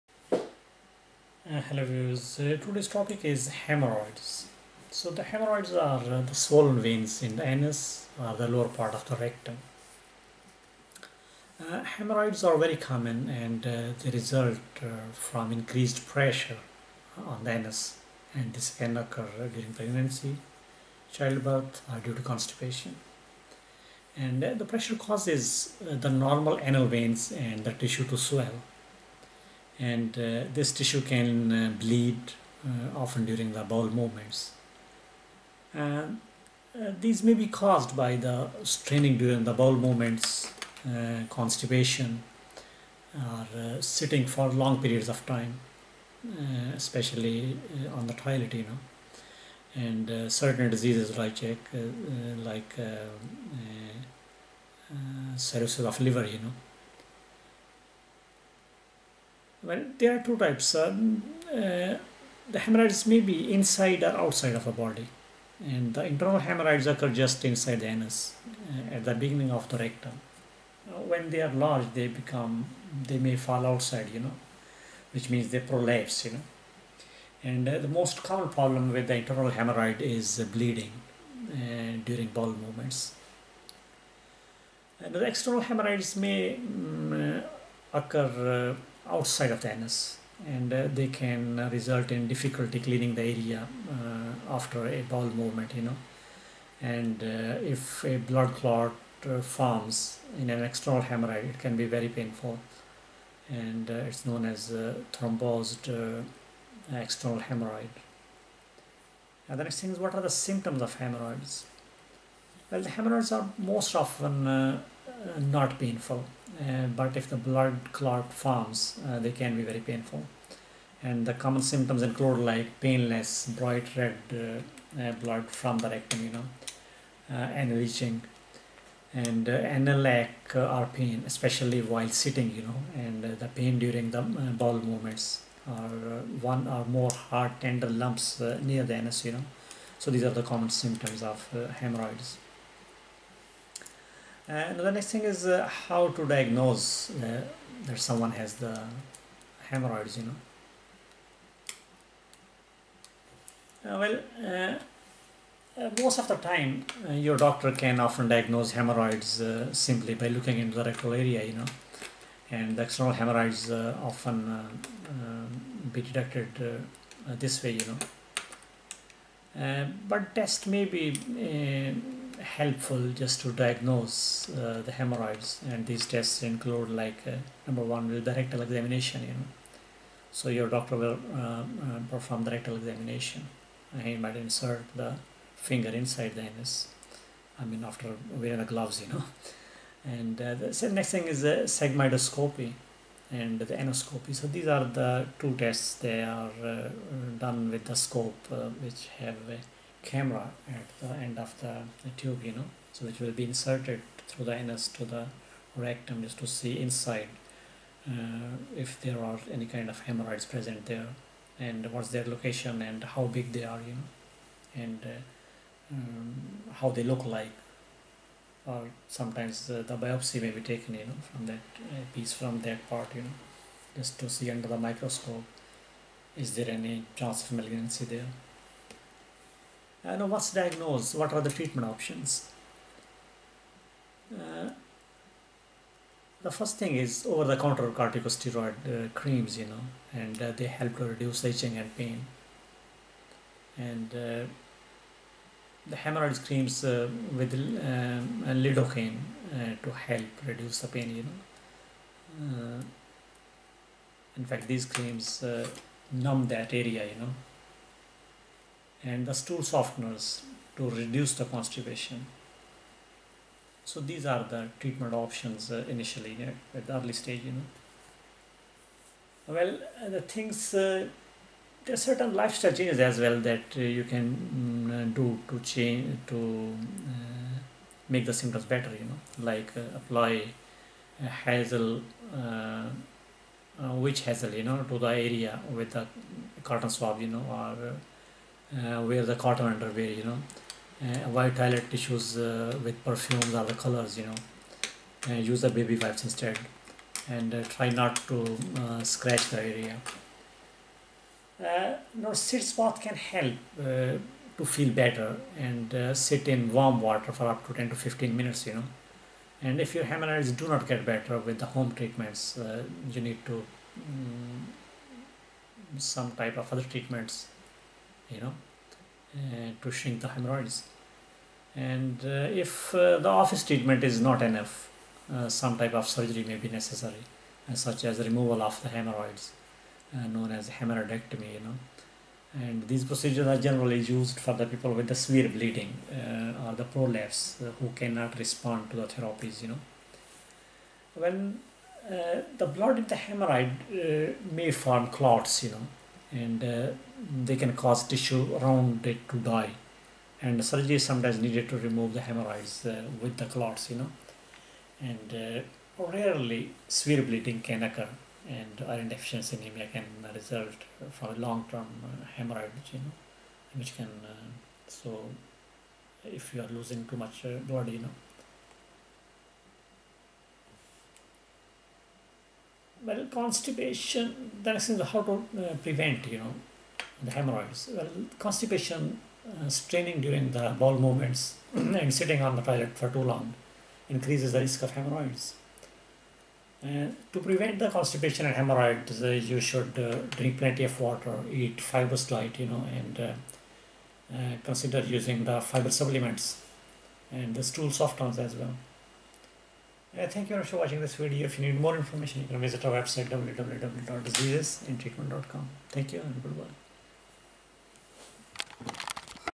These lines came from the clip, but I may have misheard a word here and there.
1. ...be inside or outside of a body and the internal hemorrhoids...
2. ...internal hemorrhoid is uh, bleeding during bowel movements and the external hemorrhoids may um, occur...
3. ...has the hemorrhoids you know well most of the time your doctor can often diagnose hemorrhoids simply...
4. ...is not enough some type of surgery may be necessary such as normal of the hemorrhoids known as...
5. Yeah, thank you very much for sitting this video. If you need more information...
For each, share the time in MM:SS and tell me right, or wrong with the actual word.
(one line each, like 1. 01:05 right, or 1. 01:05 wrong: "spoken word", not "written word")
1. 01:03 right
2. 01:19 right
3. 02:28 right
4. 05:24 wrong: "removal", not "normal"
5. 06:40 wrong: "watching", not "sitting".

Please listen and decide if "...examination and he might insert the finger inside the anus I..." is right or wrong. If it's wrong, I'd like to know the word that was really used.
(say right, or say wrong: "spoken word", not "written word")
right.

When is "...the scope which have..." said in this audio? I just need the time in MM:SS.
03:17.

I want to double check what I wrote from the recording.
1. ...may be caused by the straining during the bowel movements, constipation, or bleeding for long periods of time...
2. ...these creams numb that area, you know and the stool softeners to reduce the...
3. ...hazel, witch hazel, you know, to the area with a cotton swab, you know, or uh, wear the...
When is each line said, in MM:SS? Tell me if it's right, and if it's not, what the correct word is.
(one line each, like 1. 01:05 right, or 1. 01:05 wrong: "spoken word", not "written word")
1. 00:37 wrong: "sitting", not "bleeding"
2. 04:14 right
3. 04:41 right.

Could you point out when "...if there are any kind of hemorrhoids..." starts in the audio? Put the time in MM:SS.
03:28.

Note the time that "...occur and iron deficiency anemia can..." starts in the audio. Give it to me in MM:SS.
05:57.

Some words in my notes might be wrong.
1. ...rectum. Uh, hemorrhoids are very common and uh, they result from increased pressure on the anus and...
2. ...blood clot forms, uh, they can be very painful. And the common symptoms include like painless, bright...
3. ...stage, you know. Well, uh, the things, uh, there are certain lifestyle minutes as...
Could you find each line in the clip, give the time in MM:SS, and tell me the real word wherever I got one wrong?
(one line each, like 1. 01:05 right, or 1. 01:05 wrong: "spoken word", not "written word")
1. 00:09 right
2. 01:57 right
3. 04:27 wrong: "changes", not "minutes".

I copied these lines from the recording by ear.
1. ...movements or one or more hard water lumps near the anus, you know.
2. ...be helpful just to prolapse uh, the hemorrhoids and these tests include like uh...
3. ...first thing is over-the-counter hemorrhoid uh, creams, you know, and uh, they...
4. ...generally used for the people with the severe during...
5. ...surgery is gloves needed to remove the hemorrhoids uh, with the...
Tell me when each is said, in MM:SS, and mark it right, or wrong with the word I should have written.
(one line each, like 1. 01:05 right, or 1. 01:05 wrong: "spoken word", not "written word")
1. 02:14 wrong: "tender", not "water"
2. 02:50 wrong: "diagnose", not "prolapse"
3. 03:56 wrong: "corticosteroid", not "hemorrhoid"
4. 05:33 wrong: "bleeding", not "during"
5. 05:50 wrong: "sometimes", not "gloves".